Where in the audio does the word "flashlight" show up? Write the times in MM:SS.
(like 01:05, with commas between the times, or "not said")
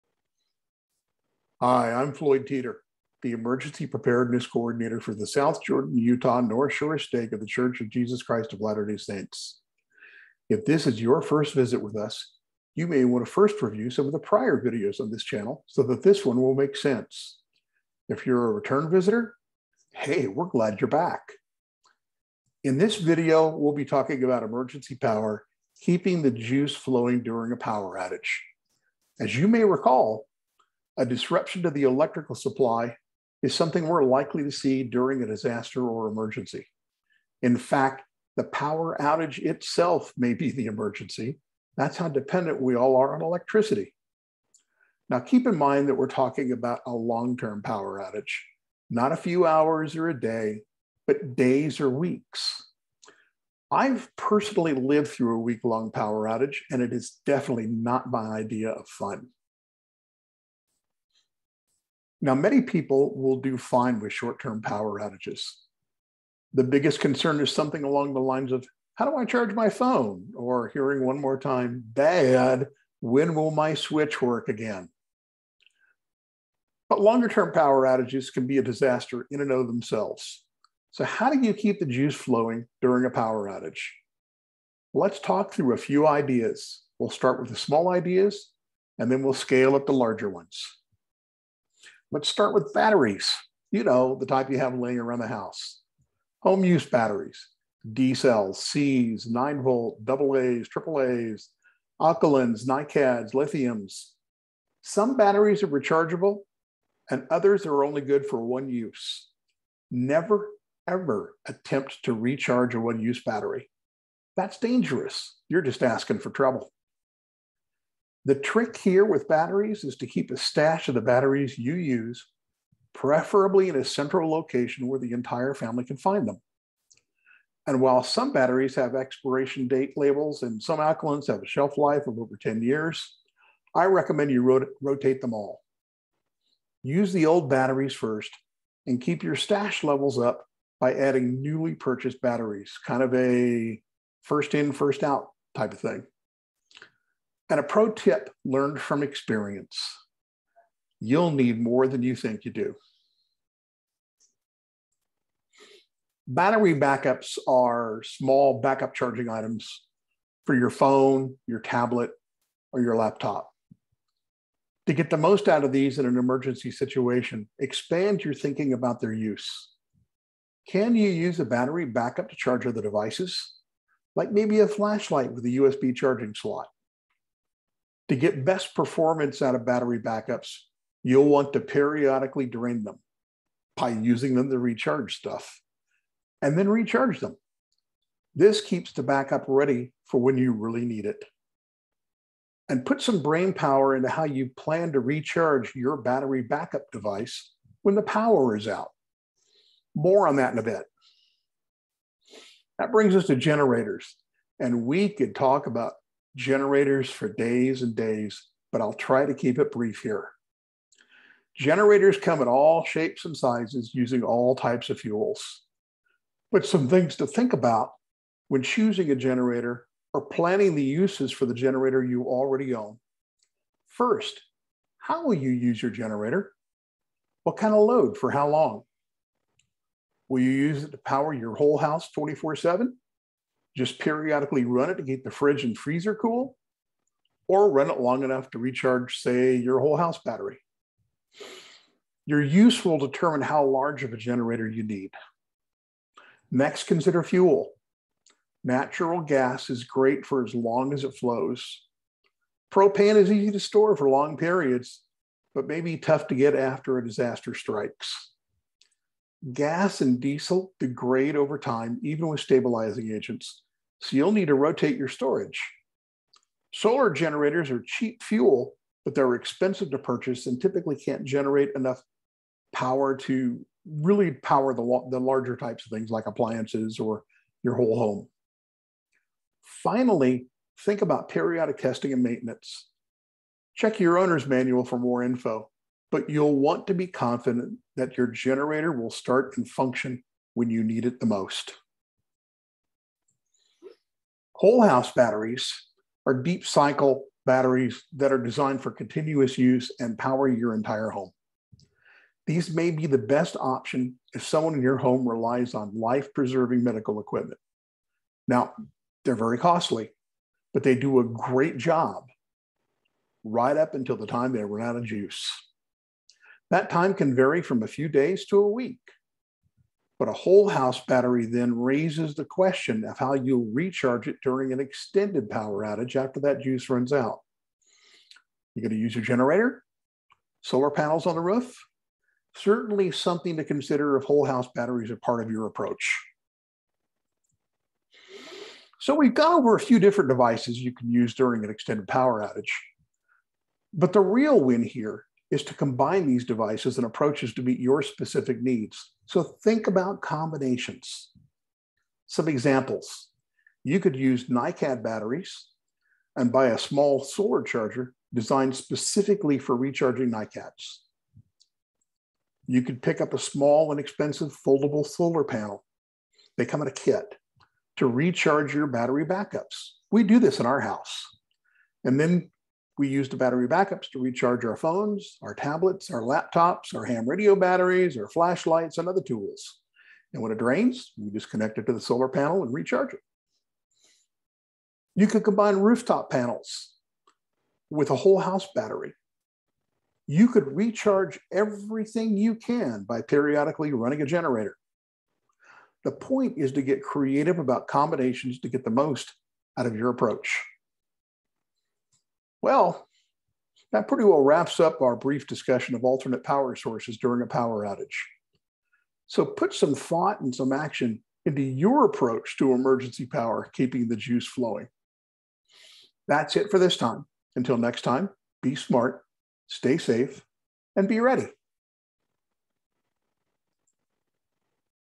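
02:54, 06:18.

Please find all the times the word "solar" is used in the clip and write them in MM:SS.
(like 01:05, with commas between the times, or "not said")
04:26, 05:30, 05:57, 06:05, 06:21.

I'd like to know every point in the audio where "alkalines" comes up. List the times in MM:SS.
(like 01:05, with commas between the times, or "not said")
01:42, 02:10.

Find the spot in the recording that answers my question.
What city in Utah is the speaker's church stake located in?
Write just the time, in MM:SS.
00:05.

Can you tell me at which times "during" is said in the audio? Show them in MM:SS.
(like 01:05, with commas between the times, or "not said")
00:27, 00:34, 01:22, 05:24, 05:41, 06:47.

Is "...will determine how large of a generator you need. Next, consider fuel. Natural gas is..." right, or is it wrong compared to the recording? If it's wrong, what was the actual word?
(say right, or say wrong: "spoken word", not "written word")
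right.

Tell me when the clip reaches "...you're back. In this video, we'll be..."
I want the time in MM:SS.
00:20.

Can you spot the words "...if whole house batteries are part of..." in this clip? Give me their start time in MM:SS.
05:34.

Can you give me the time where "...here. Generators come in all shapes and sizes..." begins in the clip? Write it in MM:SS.
03:30.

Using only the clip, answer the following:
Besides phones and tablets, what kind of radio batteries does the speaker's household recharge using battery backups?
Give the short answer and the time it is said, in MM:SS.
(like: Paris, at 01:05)
Ham radio, at 06:17.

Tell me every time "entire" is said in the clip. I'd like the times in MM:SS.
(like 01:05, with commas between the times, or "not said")
02:05, 05:00.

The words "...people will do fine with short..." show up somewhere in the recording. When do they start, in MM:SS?
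01:02.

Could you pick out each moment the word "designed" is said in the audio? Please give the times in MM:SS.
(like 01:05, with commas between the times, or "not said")
04:58, 05:58.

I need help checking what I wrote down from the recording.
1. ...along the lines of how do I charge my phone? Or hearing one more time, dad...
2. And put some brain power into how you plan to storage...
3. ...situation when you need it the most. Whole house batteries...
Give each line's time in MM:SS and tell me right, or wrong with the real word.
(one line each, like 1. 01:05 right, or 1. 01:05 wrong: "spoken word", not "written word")
1. 01:07 right
2. 03:12 wrong: "recharge", not "storage"
3. 04:49 wrong: "function", not "situation".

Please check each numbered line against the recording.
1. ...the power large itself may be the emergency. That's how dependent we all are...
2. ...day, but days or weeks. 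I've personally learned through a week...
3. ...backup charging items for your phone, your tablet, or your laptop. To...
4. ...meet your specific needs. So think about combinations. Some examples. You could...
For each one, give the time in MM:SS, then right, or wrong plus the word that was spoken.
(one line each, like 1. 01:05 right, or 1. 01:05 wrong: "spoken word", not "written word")
1. 00:38 wrong: "outage", not "large"
2. 00:50 wrong: "lived", not "learned"
3. 02:38 right
4. 05:47 right.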